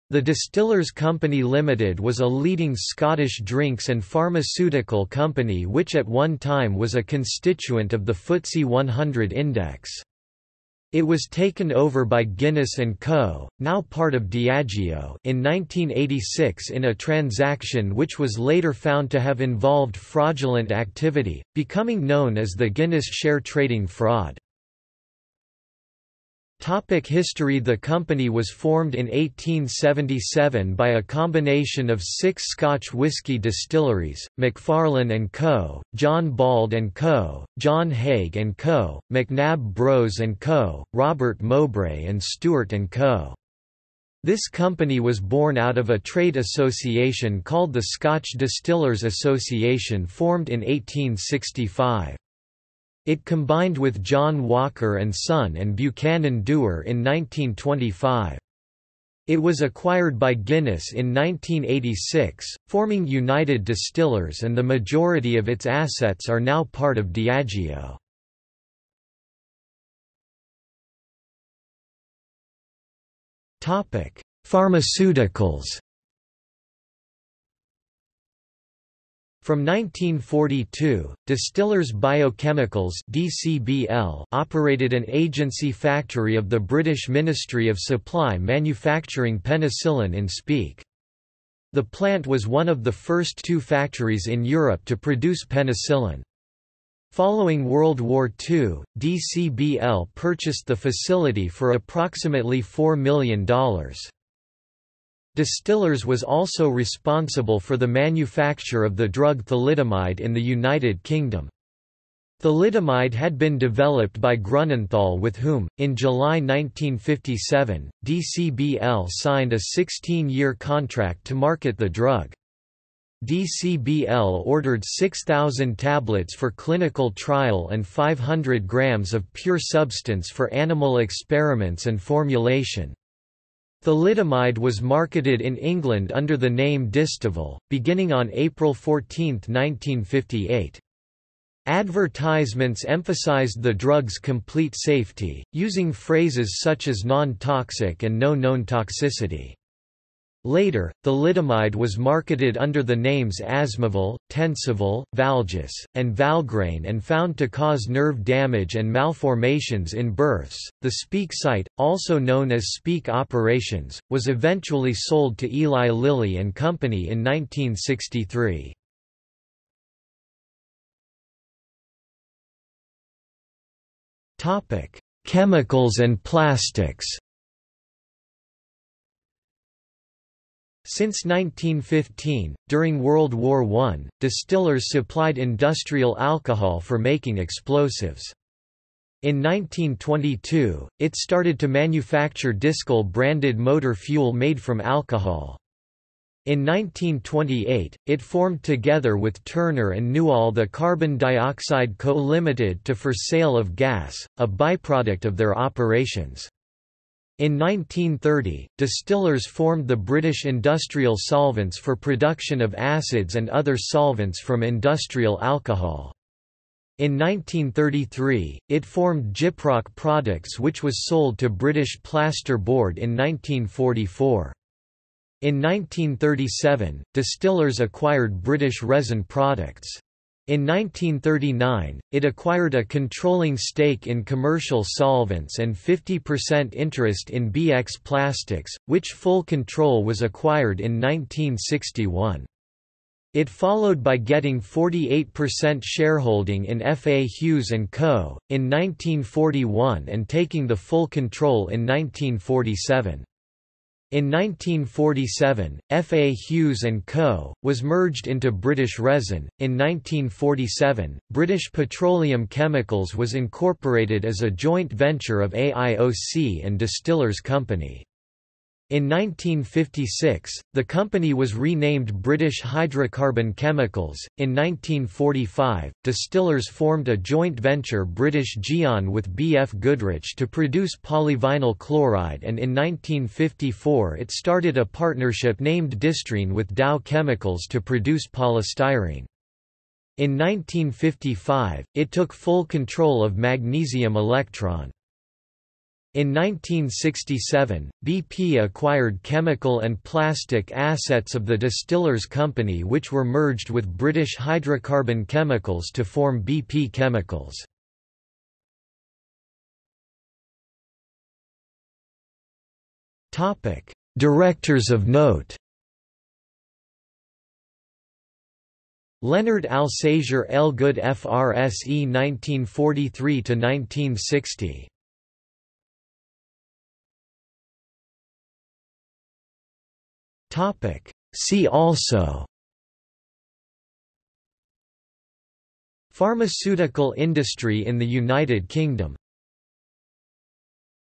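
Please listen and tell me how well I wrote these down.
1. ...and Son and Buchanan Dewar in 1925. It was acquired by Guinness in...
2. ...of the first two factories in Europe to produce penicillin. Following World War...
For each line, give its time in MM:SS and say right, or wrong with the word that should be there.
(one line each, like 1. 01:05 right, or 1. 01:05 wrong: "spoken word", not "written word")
1. 00:54 right
2. 01:32 right.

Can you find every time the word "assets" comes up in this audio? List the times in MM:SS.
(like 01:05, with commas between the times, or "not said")
01:05, 05:00.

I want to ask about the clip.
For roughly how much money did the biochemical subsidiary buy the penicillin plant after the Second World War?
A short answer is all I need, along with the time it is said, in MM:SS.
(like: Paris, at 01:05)
$4 million, at 01:42.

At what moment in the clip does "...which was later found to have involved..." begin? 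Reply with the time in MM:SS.
00:17.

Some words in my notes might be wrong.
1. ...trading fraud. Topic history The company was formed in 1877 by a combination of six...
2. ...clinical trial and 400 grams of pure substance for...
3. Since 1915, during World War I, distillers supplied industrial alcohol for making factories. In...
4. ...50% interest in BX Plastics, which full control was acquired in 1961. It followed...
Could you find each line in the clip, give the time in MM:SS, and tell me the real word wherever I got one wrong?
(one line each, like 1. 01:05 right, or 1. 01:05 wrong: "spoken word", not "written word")
1. 00:23 right
2. 02:06 wrong: "500", not "400"
3. 03:00 wrong: "explosives", not "factories"
4. 03:55 right.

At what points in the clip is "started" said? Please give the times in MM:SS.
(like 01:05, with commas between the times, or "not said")
03:11, 04:44.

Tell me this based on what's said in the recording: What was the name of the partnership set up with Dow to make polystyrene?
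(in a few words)
Distrine.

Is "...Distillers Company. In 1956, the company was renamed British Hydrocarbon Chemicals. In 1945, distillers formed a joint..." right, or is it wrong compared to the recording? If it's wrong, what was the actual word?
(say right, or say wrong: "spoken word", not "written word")
right.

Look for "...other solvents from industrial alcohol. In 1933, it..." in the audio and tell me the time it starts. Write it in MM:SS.
03:33.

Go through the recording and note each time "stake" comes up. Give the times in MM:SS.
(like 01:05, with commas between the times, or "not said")
03:53.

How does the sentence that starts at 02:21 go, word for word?
Advertisements emphasized the drug's complete safety, using phrases such as non-toxic and no known toxicity.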